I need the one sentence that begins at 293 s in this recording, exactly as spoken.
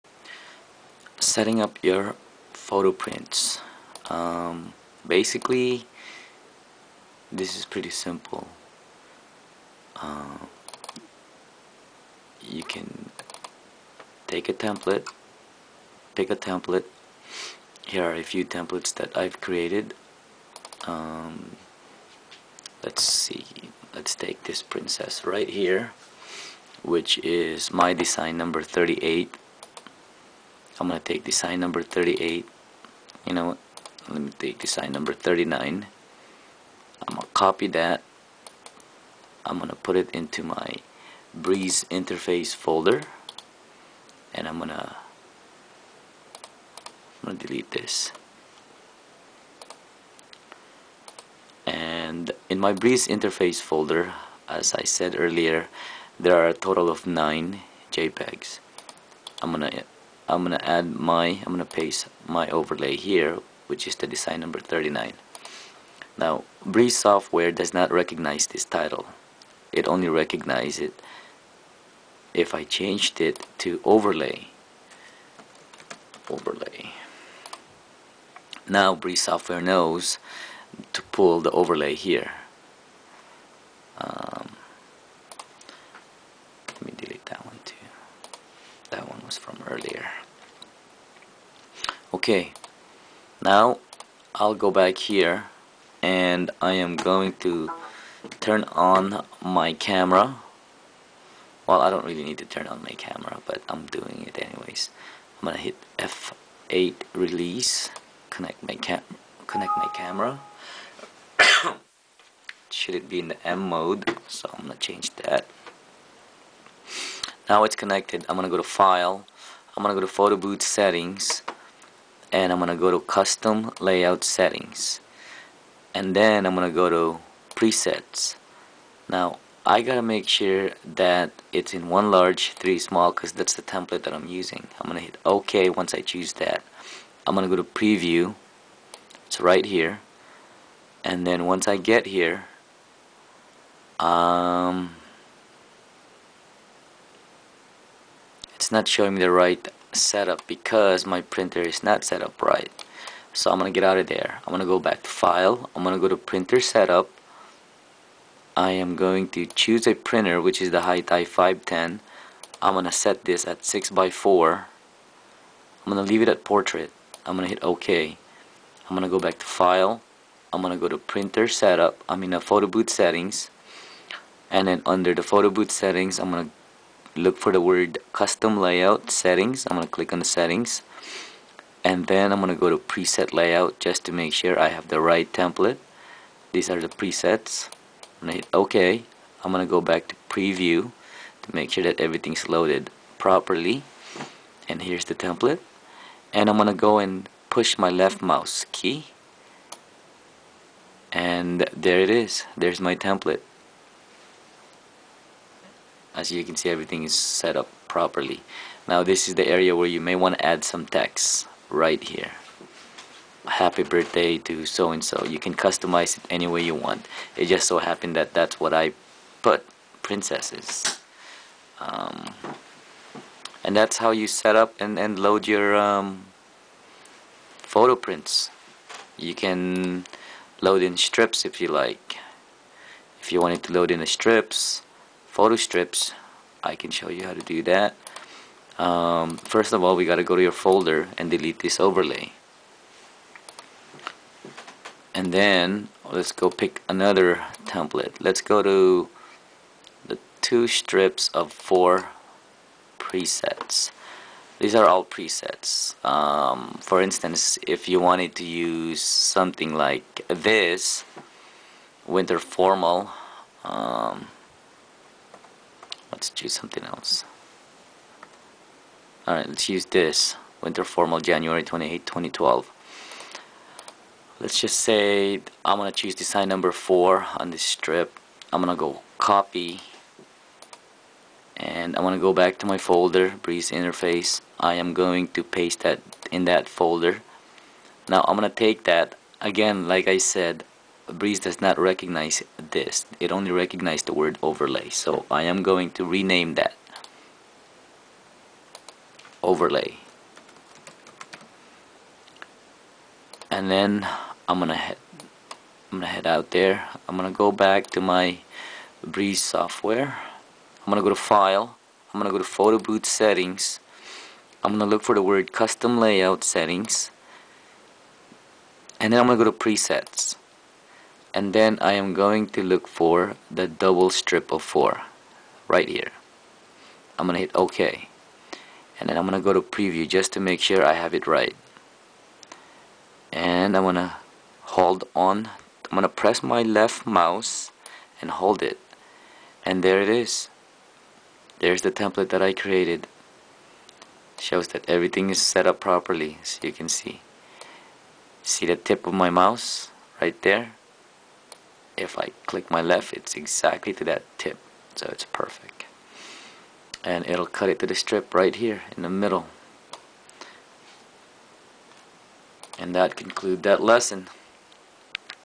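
It only recognized the word overlay.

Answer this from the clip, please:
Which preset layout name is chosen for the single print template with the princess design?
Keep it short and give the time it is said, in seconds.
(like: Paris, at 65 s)
one large three small, at 131 s.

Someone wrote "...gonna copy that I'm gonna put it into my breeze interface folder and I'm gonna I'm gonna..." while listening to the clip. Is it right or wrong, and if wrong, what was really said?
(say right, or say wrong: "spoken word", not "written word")
right.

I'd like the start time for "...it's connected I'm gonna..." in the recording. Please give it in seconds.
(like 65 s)
117 s.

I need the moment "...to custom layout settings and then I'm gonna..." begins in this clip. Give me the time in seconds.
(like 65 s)
122 s.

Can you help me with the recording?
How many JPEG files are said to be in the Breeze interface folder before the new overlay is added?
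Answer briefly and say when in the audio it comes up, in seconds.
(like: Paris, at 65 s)
9, at 57 s.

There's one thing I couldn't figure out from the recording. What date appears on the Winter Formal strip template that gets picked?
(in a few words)
January 28, 2012.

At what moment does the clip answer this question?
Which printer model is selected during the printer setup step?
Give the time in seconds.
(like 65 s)
160 s.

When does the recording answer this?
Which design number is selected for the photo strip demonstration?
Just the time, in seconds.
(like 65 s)
276 s.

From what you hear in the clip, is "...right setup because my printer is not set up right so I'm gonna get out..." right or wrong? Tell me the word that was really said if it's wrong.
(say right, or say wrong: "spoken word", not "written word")
right.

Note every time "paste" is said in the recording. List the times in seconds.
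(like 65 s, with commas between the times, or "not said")
61 s, 285 s.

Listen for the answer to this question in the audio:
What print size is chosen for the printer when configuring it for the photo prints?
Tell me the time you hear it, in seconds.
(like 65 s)
163 s.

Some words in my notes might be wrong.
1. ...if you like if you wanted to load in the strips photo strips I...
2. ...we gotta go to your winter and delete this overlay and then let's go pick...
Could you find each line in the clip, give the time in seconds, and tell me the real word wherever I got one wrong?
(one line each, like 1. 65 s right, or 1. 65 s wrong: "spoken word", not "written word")
1. 231 s right
2. 239 s wrong: "folder", not "winter".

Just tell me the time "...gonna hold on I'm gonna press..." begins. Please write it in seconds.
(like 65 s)
333 s.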